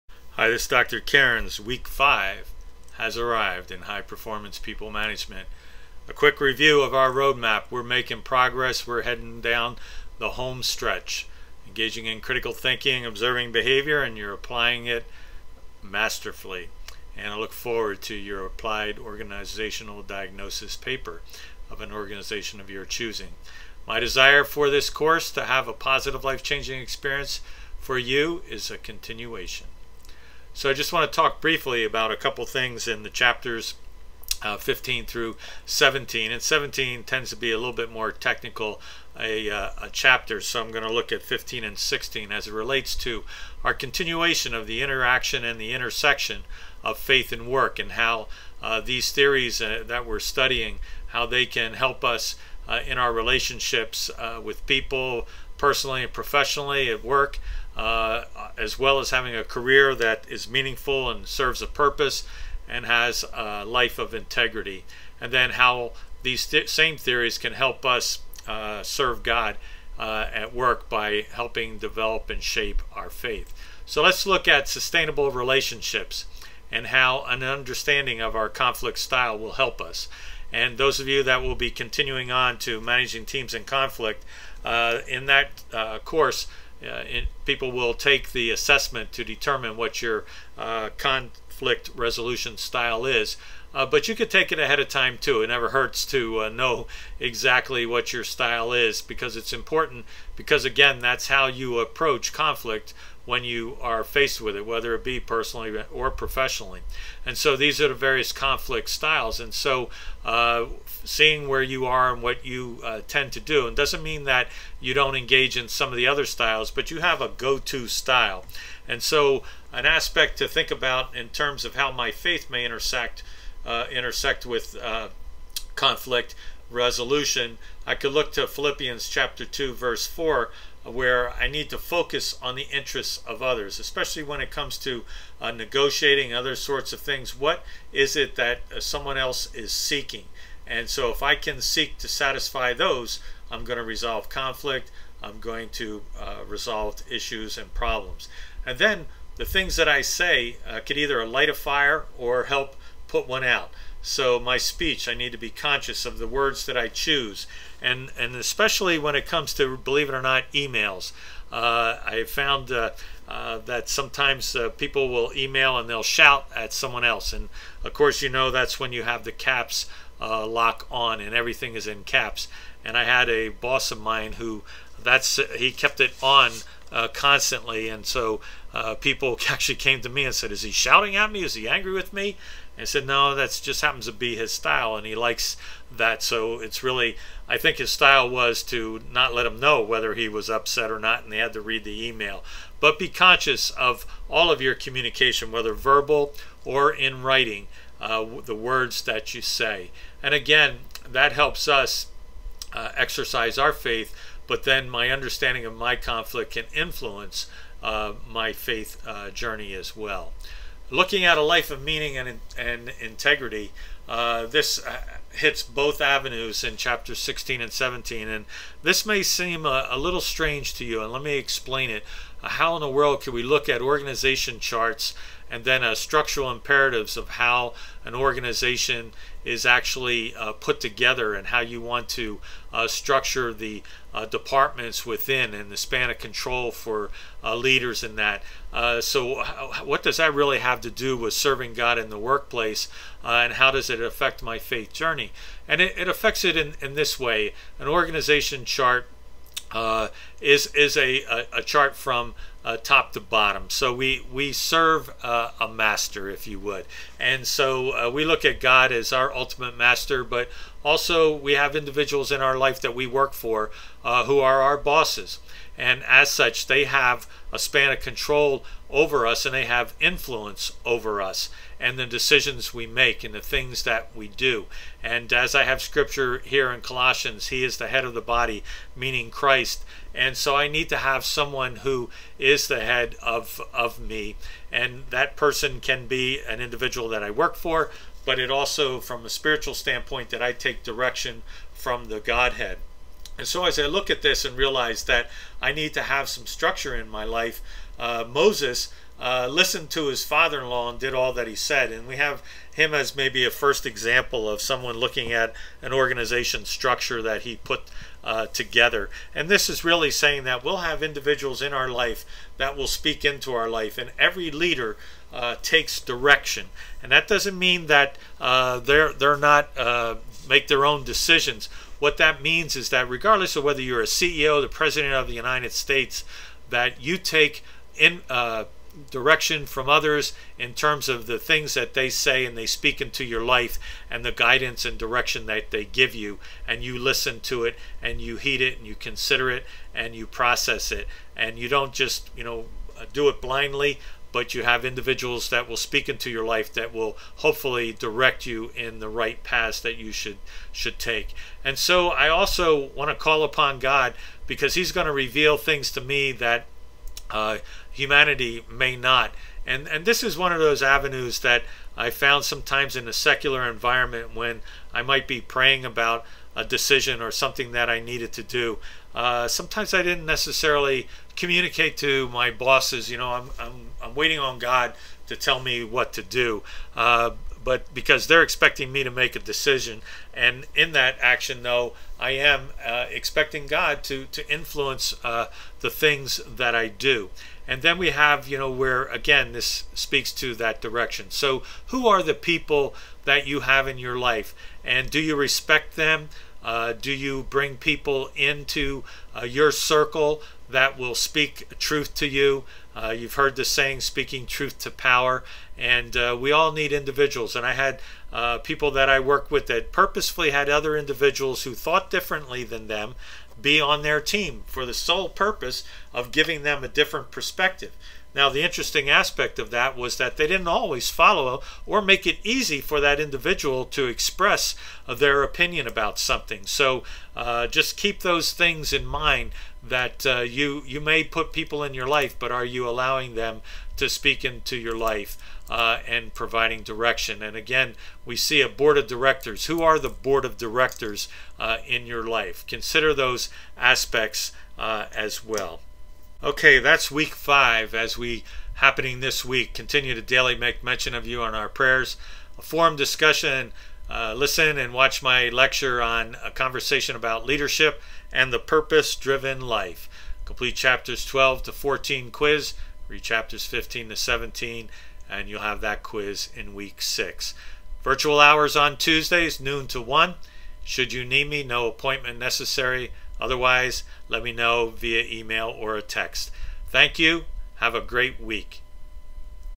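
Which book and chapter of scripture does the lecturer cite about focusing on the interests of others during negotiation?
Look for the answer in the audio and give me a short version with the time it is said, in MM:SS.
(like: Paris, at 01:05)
Philippians chapter 2, at 02:08.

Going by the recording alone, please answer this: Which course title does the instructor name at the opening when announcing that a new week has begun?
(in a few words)
High Performance People Management.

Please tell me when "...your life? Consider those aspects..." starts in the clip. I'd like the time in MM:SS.
07:22.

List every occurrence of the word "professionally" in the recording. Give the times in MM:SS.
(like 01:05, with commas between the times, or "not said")
00:56, 01:46.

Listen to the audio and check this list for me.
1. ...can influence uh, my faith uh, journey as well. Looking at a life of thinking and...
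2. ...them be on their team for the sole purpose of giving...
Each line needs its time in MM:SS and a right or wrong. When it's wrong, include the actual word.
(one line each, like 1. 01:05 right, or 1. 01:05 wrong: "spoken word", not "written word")
1. 03:26 wrong: "meaning", not "thinking"
2. 06:52 right.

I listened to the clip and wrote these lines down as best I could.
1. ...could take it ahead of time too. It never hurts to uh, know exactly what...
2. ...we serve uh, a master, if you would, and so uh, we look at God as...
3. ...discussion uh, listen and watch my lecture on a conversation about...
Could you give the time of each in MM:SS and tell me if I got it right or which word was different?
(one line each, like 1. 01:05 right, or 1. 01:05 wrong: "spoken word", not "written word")
1. 01:34 right
2. 04:14 right
3. 07:32 right.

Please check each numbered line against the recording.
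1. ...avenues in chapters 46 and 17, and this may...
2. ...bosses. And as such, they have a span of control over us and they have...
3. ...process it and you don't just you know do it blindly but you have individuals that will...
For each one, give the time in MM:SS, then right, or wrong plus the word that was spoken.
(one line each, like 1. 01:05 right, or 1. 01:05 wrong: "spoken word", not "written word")
1. 03:36 wrong: "16", not "46"
2. 04:24 right
3. 05:40 right.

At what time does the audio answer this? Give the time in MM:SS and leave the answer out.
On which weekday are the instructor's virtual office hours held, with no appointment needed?
07:48.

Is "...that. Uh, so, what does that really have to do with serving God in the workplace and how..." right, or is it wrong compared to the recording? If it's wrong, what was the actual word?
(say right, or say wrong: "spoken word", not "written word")
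right.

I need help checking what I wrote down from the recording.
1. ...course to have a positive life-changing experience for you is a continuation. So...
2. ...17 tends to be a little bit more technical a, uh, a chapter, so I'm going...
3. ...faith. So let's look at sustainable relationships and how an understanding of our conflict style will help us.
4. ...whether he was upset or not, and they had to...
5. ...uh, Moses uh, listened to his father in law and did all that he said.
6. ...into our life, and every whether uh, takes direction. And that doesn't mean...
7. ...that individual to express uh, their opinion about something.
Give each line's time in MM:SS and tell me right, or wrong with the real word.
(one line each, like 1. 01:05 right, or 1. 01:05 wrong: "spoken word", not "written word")
1. 00:24 right
2. 00:36 right
3. 01:13 right
4. 03:09 right
5. 04:57 right
6. 05:13 wrong: "leader", not "whether"
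7. 07:03 right.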